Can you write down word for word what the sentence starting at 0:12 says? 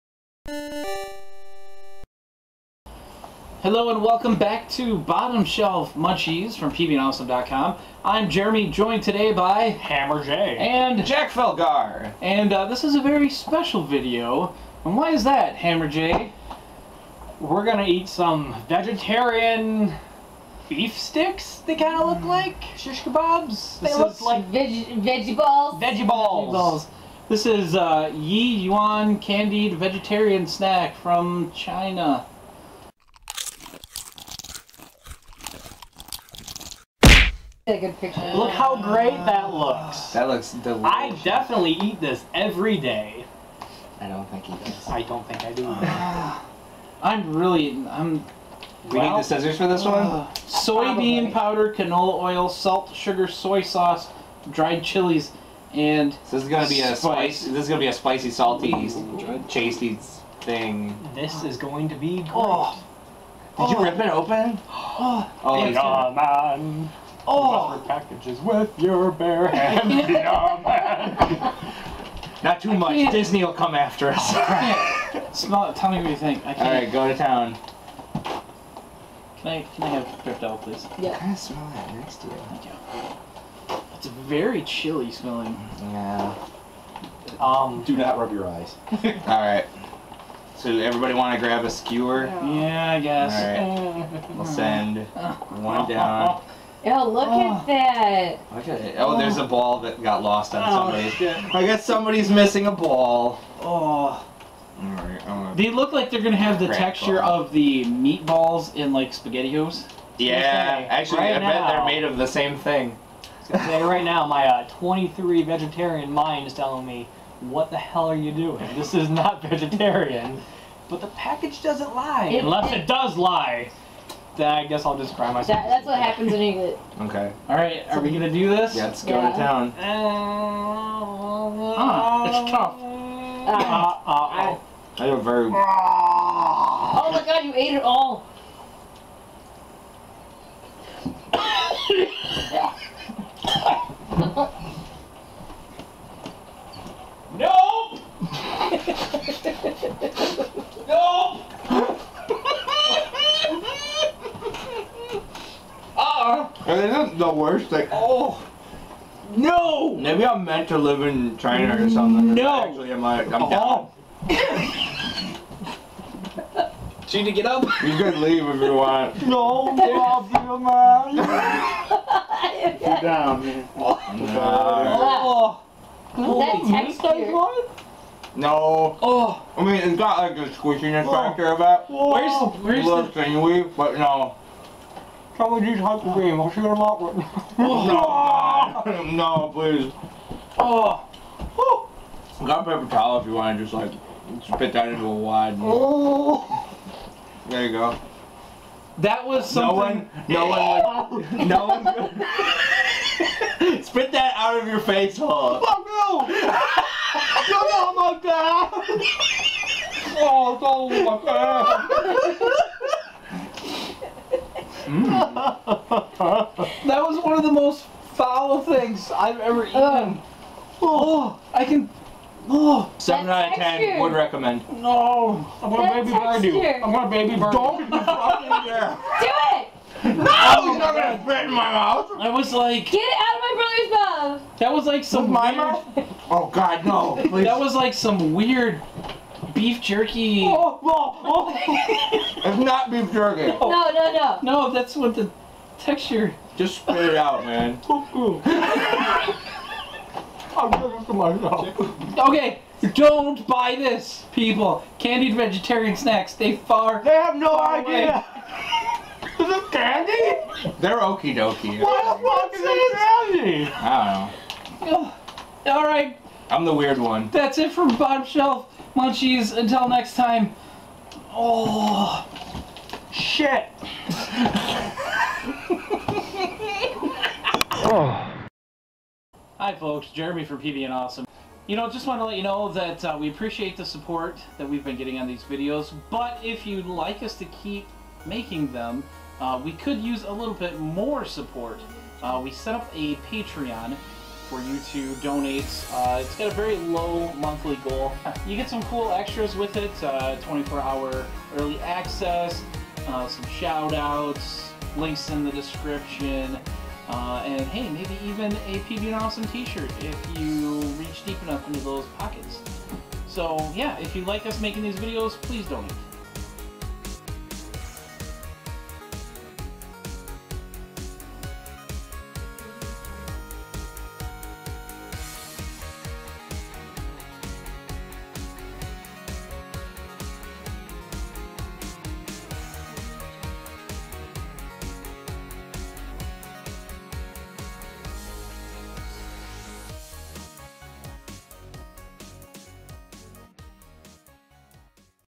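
And uh, this is a very special video.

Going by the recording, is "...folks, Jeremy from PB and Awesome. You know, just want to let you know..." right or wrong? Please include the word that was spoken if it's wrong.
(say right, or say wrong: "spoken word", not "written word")
right.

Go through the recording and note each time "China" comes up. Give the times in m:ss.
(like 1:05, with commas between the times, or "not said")
0:31, 2:41.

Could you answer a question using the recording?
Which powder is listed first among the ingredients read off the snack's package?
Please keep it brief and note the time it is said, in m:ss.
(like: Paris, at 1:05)
soybean powder, at 0:50.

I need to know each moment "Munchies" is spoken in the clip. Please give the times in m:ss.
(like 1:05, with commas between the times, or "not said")
0:05, 4:28.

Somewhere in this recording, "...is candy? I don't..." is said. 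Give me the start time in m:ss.
4:23.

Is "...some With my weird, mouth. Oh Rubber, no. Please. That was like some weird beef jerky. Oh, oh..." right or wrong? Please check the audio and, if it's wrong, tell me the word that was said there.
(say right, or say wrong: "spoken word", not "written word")
wrong: "God", not "Rubber".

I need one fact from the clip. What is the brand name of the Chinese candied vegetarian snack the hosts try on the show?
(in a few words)
Yi Yuan.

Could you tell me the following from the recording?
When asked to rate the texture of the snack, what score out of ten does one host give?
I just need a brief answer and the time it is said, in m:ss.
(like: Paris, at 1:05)
7, at 3:42.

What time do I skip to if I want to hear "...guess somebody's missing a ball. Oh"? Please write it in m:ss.
1:41.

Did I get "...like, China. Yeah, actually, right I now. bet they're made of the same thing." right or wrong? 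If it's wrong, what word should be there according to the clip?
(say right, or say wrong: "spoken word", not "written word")
wrong: "SpaghettiOs", not "China".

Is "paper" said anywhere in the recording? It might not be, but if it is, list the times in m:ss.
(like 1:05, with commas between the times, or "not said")
3:12.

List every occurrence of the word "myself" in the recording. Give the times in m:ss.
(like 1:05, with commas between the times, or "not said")
2:05, 4:11.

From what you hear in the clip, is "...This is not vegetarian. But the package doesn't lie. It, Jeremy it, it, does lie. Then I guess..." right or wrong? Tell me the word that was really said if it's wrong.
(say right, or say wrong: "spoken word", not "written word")
wrong: "Unless", not "Jeremy".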